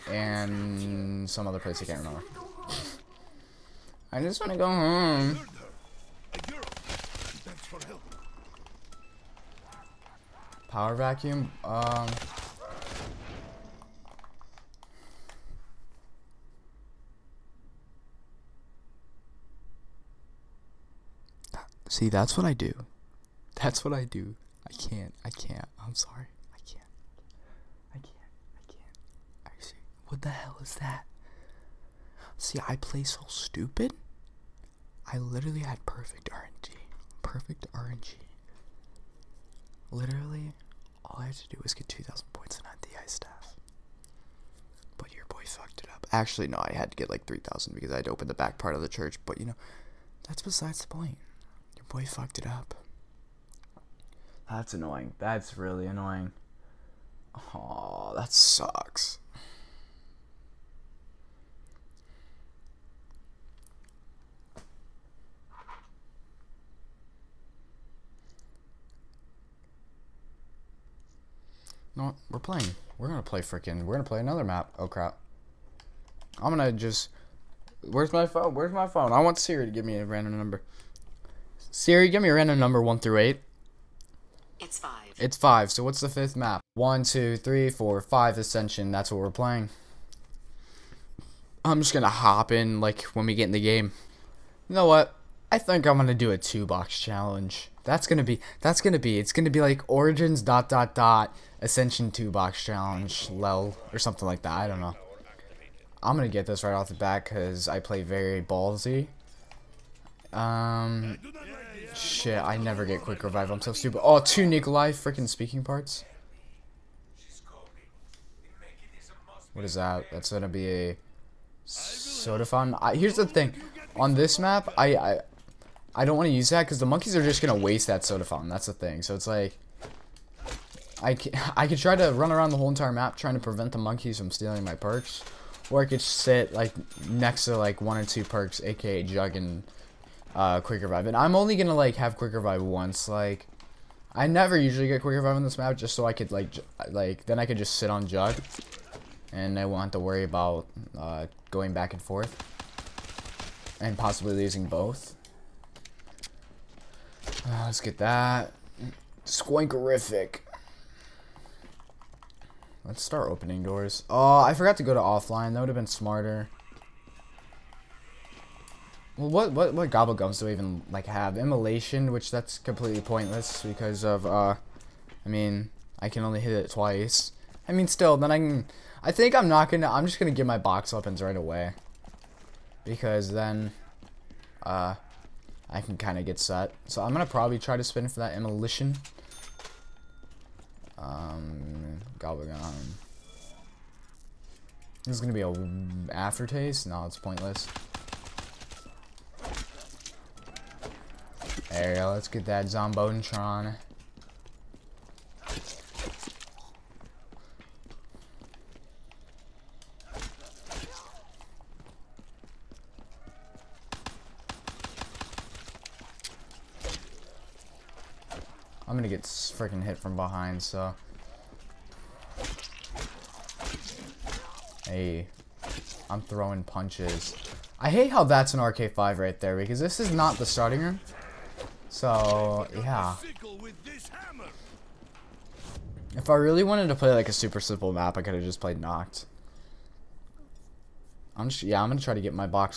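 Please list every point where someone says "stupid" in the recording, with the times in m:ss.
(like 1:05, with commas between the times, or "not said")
0:33, 1:53.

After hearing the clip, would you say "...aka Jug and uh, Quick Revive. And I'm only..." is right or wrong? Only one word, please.
right.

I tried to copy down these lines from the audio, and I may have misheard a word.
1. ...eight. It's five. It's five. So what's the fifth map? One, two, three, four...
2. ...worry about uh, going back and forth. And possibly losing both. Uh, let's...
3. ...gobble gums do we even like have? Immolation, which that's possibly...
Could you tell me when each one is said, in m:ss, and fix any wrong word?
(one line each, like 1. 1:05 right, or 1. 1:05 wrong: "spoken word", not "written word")
1. 1:23 right
2. 2:29 right
3. 2:49 wrong: "completely", not "possibly".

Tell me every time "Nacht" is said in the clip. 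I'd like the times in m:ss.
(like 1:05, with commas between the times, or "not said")
3:58.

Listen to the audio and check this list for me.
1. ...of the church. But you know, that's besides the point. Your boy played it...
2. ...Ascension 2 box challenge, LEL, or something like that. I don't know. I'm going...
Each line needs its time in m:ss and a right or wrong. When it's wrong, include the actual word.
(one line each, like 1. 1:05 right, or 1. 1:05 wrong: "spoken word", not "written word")
1. 0:48 wrong: "fucked", not "played"
2. 1:41 right.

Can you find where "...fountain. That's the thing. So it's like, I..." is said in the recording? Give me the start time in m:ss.
2:08.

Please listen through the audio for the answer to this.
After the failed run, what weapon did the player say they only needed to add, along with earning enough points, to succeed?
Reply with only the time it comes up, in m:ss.
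0:43.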